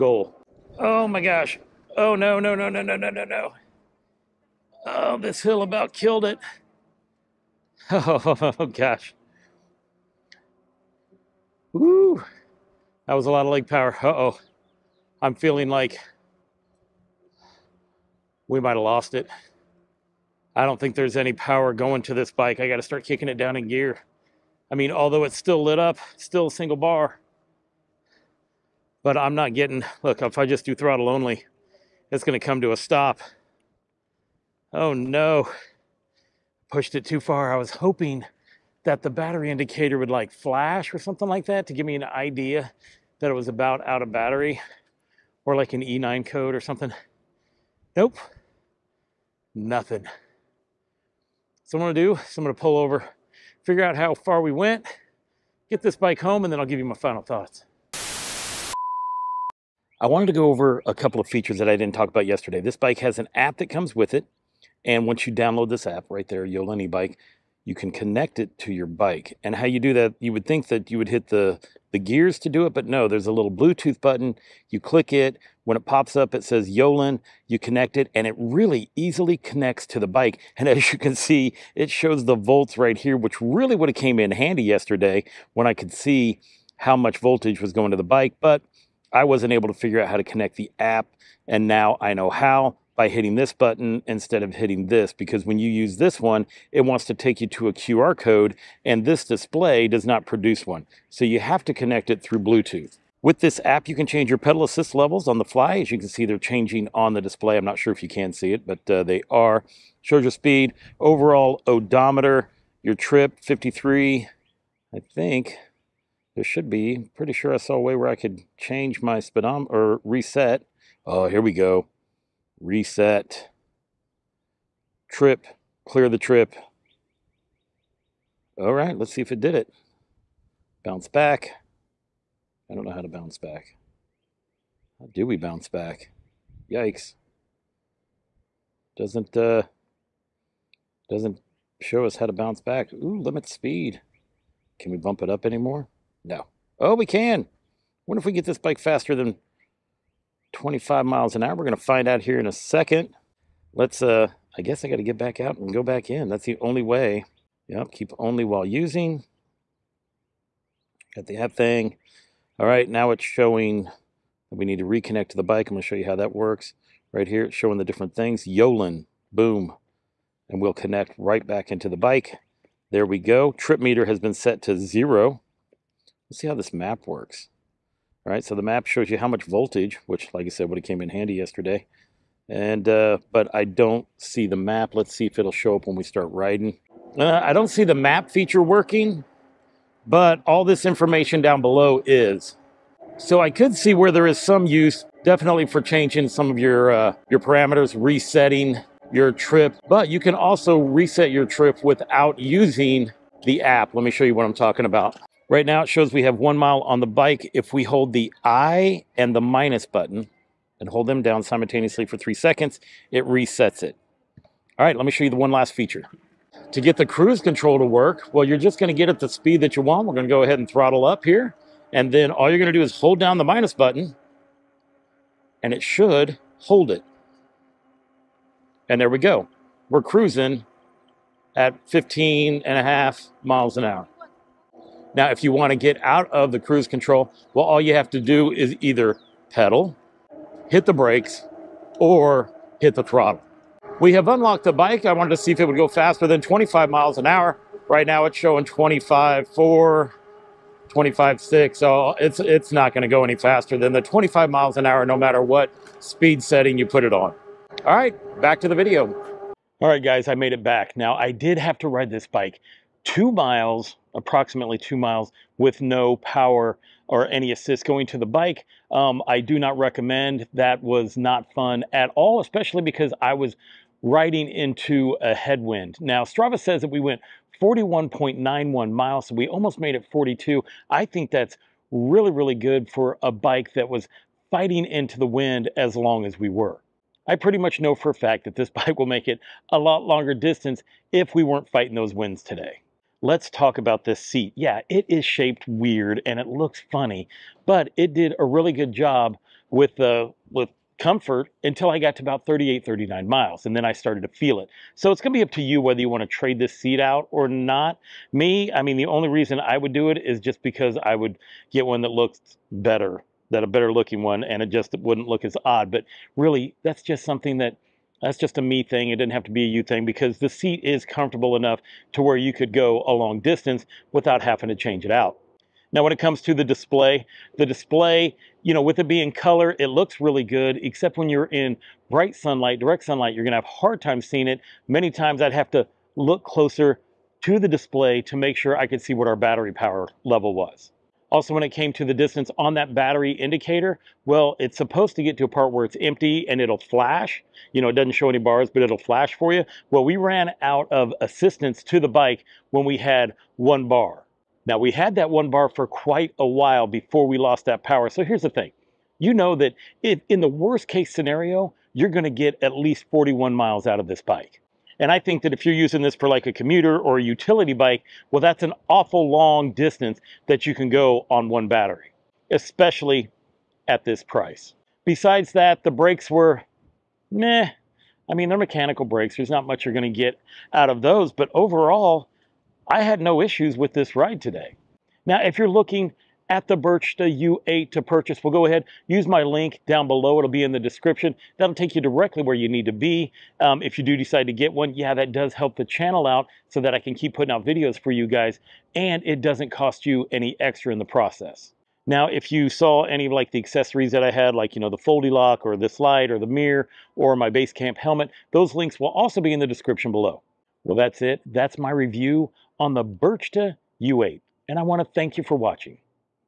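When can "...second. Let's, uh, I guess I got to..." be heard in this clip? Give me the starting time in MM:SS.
02:32.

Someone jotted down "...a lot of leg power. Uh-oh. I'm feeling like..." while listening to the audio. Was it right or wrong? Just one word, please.
right.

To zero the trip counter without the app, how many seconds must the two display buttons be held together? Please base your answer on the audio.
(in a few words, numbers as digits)
3 seconds.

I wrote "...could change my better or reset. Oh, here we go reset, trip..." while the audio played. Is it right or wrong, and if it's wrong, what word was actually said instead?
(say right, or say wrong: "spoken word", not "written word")
wrong: "speedometer", not "better".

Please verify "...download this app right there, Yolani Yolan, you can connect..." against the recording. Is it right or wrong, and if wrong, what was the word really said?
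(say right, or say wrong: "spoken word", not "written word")
wrong: "Bike", not "Yolan".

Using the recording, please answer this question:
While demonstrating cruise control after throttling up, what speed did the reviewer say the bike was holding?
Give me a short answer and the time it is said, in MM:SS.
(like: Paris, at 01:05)
15.5 miles per hour, at 03:51.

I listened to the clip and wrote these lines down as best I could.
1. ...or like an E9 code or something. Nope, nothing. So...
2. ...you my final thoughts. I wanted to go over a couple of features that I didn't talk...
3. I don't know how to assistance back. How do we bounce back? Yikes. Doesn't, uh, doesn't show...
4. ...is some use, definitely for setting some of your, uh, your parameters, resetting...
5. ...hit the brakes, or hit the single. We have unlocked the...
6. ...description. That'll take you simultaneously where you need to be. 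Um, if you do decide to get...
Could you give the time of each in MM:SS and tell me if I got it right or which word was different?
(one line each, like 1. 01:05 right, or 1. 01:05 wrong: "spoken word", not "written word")
1. 00:45 right
2. 00:56 right
3. 02:12 wrong: "bounce", not "assistance"
4. 03:14 wrong: "changing", not "setting"
5. 04:00 wrong: "throttle", not "single"
6. 06:30 wrong: "directly", not "simultaneously".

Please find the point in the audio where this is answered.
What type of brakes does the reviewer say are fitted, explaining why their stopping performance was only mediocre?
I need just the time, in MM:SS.
06:18.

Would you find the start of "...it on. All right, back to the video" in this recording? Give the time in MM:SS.
04:17.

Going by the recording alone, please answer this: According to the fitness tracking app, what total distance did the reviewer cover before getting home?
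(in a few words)
41.91 miles.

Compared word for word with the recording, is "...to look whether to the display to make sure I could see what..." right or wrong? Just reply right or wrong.
wrong.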